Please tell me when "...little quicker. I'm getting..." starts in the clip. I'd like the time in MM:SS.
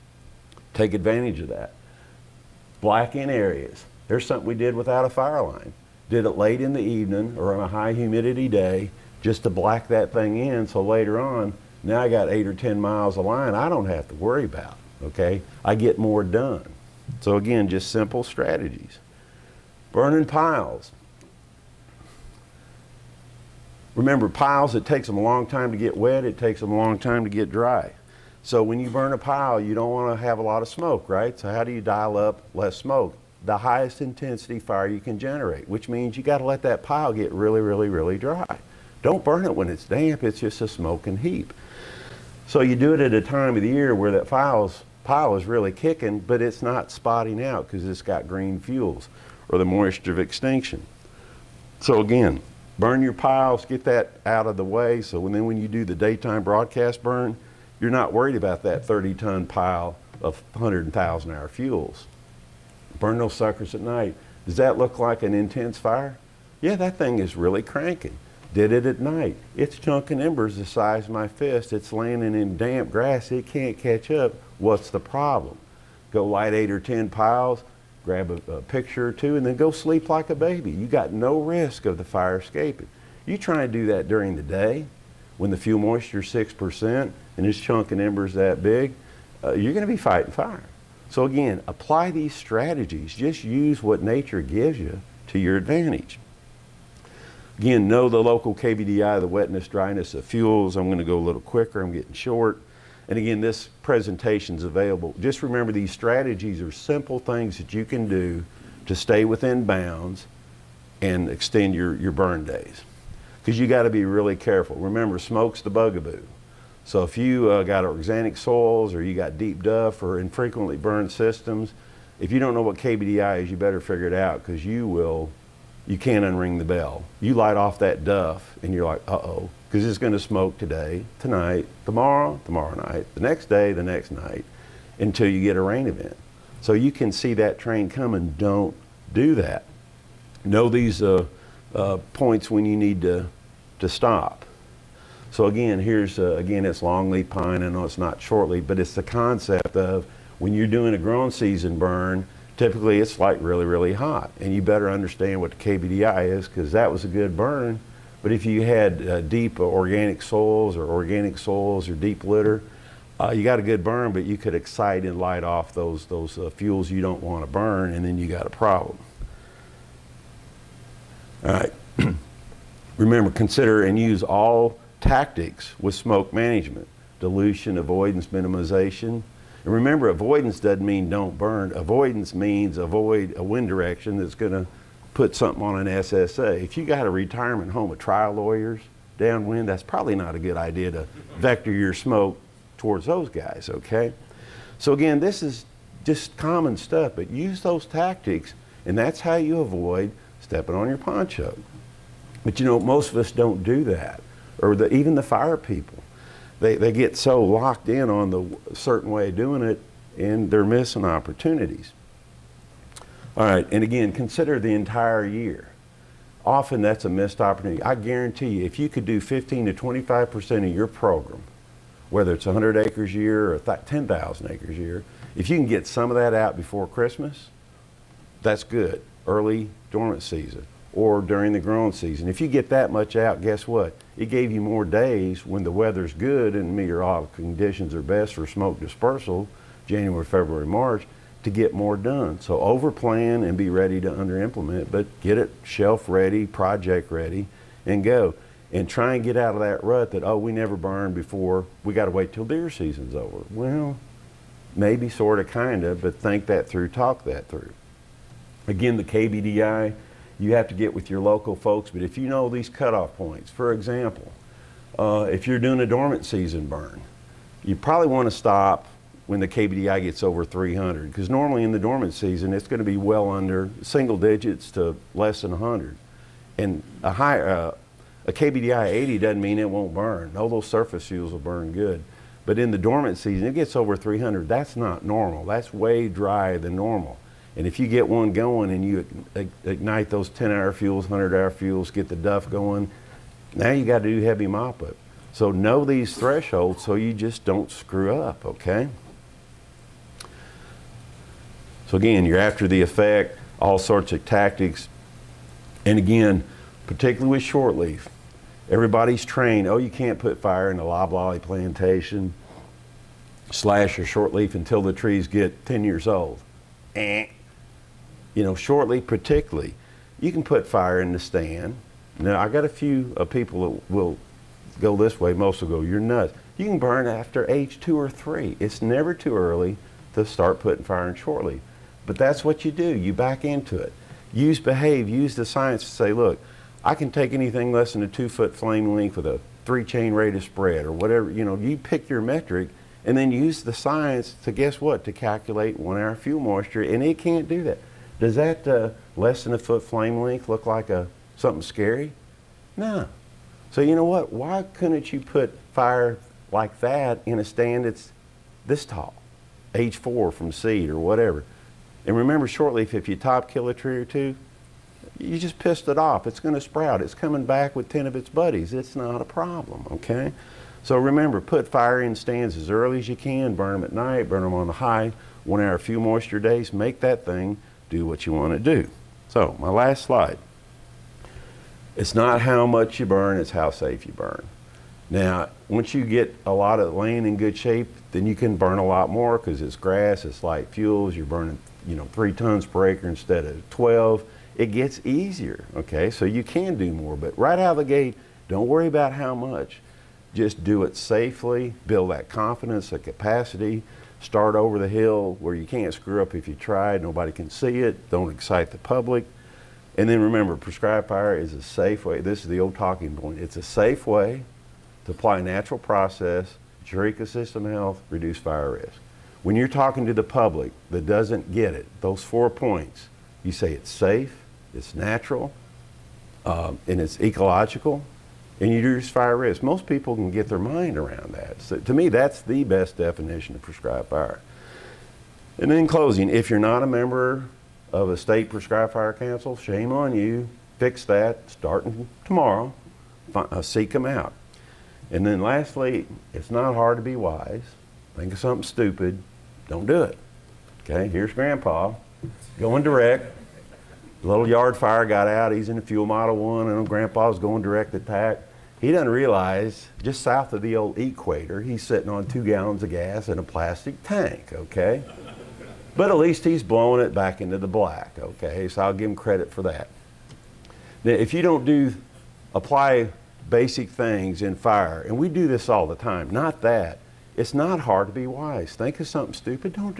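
01:41.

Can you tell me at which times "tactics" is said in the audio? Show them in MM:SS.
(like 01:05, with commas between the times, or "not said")
02:55, 03:17, 05:04.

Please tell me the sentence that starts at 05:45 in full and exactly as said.
To calculate one hour fuel moisture.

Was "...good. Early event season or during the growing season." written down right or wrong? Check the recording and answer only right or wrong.
wrong.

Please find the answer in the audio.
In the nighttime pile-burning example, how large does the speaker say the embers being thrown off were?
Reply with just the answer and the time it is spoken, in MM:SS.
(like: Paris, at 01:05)
the size of my fist, at 01:10.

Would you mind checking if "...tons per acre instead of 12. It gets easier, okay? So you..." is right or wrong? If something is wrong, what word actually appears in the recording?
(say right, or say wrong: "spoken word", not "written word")
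right.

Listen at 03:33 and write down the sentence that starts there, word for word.
All right, and again, consider the entire year.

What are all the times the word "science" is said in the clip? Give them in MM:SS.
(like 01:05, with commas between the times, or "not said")
05:35, 05:43.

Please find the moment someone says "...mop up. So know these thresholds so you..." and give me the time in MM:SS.
04:54.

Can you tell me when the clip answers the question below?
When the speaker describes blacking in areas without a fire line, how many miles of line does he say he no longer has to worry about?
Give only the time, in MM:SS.
00:12.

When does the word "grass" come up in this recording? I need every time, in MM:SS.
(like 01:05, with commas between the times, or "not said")
01:12, 06:29.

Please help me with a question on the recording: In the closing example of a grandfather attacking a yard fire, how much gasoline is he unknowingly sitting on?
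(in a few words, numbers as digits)
2 gallons.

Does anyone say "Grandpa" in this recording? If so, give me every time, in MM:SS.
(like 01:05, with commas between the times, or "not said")
07:31, 07:36.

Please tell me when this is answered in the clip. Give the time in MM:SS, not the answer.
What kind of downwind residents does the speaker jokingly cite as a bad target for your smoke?
03:07.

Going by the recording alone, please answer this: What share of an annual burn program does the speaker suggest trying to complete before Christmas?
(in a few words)
15 to 25%.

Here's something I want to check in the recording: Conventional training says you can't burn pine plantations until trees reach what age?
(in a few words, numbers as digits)
10 years old.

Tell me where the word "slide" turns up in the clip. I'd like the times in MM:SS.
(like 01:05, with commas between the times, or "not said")
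06:20.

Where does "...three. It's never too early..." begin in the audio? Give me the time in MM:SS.
05:28.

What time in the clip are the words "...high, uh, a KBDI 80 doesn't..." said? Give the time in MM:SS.
04:37.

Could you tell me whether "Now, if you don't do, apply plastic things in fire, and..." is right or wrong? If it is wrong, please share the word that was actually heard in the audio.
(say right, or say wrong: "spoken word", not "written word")
wrong: "basic", not "plastic".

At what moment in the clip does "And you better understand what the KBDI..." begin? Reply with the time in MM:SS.
02:34.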